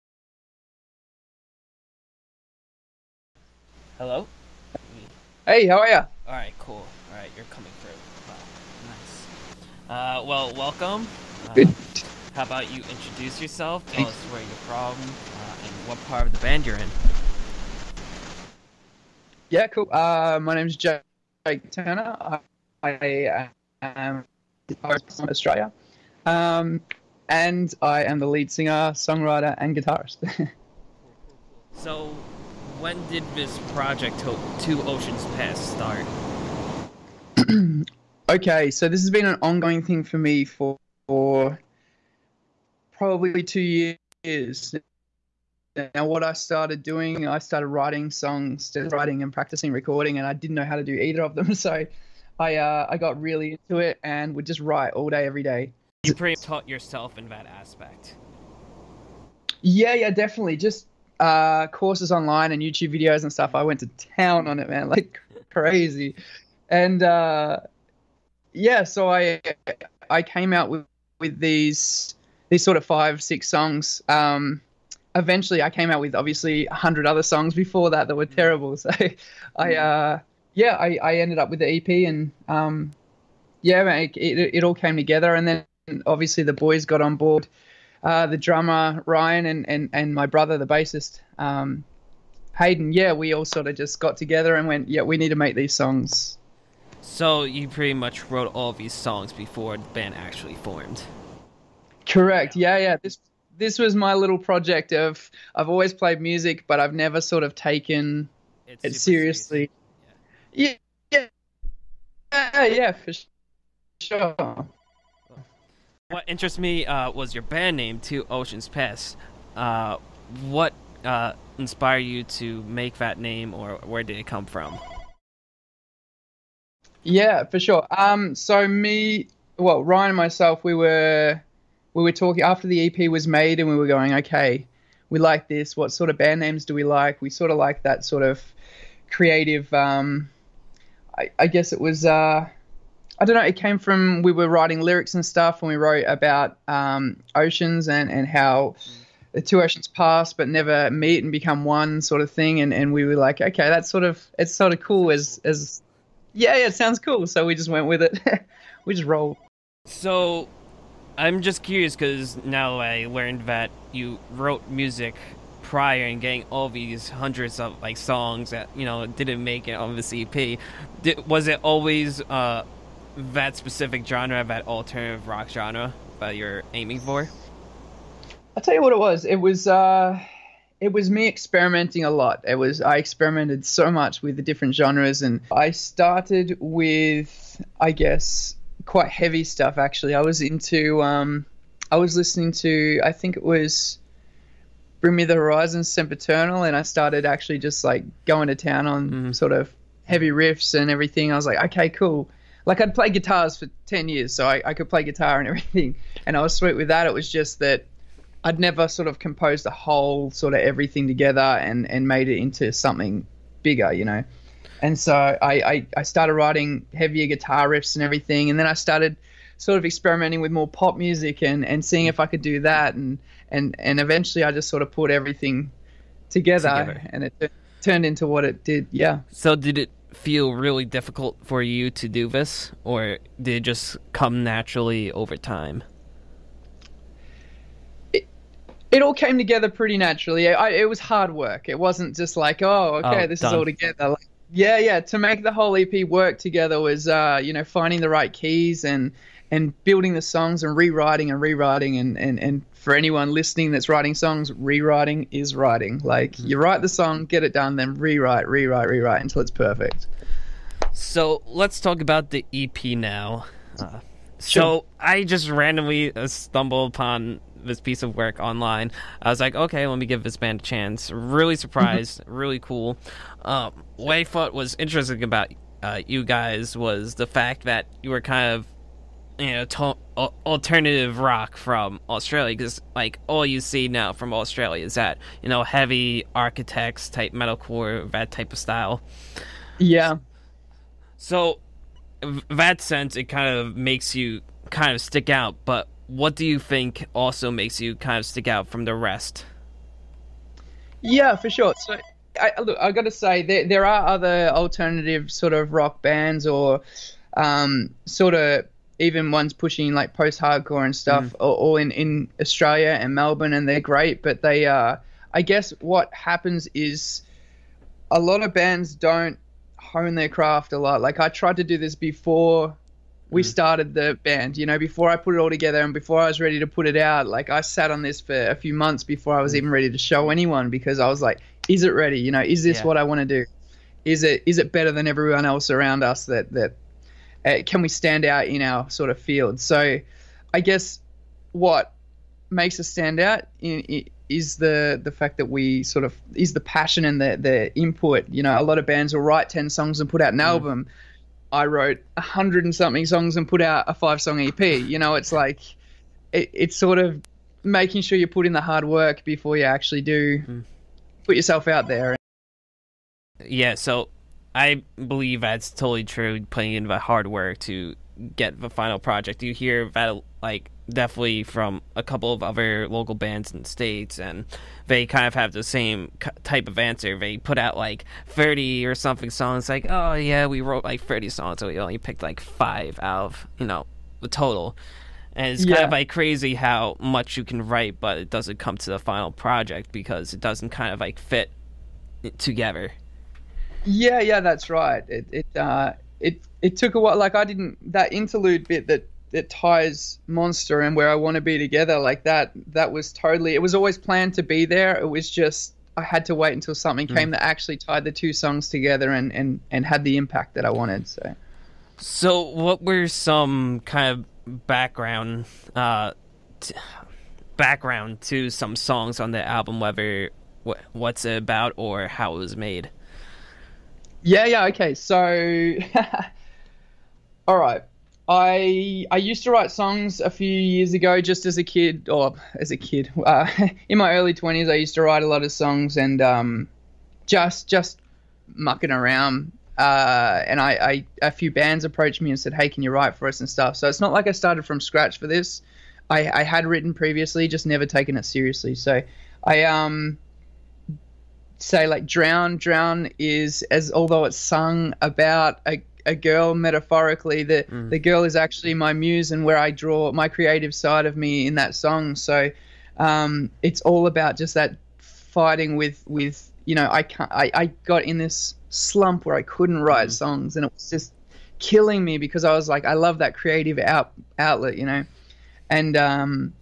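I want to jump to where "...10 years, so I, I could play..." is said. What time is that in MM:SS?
03:23.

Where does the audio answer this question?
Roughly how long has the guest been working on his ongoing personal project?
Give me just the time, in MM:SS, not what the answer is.
00:43.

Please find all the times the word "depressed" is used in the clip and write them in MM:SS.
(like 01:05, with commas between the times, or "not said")
not said.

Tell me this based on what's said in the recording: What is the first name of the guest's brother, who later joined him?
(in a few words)
Hayden.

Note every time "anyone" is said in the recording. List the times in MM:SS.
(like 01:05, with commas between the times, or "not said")
04:12, 05:30.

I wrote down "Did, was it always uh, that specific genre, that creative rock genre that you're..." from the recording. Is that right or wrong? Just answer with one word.
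wrong.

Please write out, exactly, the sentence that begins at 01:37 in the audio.
So you pretty much wrote all these songs before the band actually formed.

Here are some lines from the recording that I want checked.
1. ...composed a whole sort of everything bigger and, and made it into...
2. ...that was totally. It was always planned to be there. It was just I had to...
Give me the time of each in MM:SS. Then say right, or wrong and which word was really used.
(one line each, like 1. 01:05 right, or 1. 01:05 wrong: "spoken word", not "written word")
1. 03:29 wrong: "together", not "bigger"
2. 06:42 right.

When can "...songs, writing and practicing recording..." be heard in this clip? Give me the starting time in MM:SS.
00:48.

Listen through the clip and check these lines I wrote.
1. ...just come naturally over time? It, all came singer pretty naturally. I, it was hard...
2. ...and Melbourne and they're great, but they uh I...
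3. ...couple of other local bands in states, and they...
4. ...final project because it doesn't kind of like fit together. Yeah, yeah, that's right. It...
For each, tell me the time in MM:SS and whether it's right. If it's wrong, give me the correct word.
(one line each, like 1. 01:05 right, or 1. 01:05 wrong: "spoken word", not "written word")
1. 03:53 wrong: "together", not "singer"
2. 05:12 right
3. 06:12 right
4. 06:29 right.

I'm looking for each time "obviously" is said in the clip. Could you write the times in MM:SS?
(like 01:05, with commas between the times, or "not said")
01:16, 01:26.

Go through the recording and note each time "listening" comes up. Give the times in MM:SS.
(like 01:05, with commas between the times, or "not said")
03:12, 04:13.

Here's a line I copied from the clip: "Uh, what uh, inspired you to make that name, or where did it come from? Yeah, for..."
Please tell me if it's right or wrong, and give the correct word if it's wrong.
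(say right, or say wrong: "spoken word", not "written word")
right.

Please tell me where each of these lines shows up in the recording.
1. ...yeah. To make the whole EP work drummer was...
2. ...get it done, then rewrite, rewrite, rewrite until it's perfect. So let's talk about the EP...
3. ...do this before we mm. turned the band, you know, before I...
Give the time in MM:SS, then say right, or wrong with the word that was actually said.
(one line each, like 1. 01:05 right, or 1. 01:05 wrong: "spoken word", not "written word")
1. 04:04 wrong: "together", not "drummer"
2. 04:17 right
3. 05:21 wrong: "started", not "turned".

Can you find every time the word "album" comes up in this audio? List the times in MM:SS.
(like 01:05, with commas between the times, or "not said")
05:50, 06:59.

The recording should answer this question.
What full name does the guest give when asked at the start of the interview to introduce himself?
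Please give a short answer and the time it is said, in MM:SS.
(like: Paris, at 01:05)
Jake Turner, at 00:20.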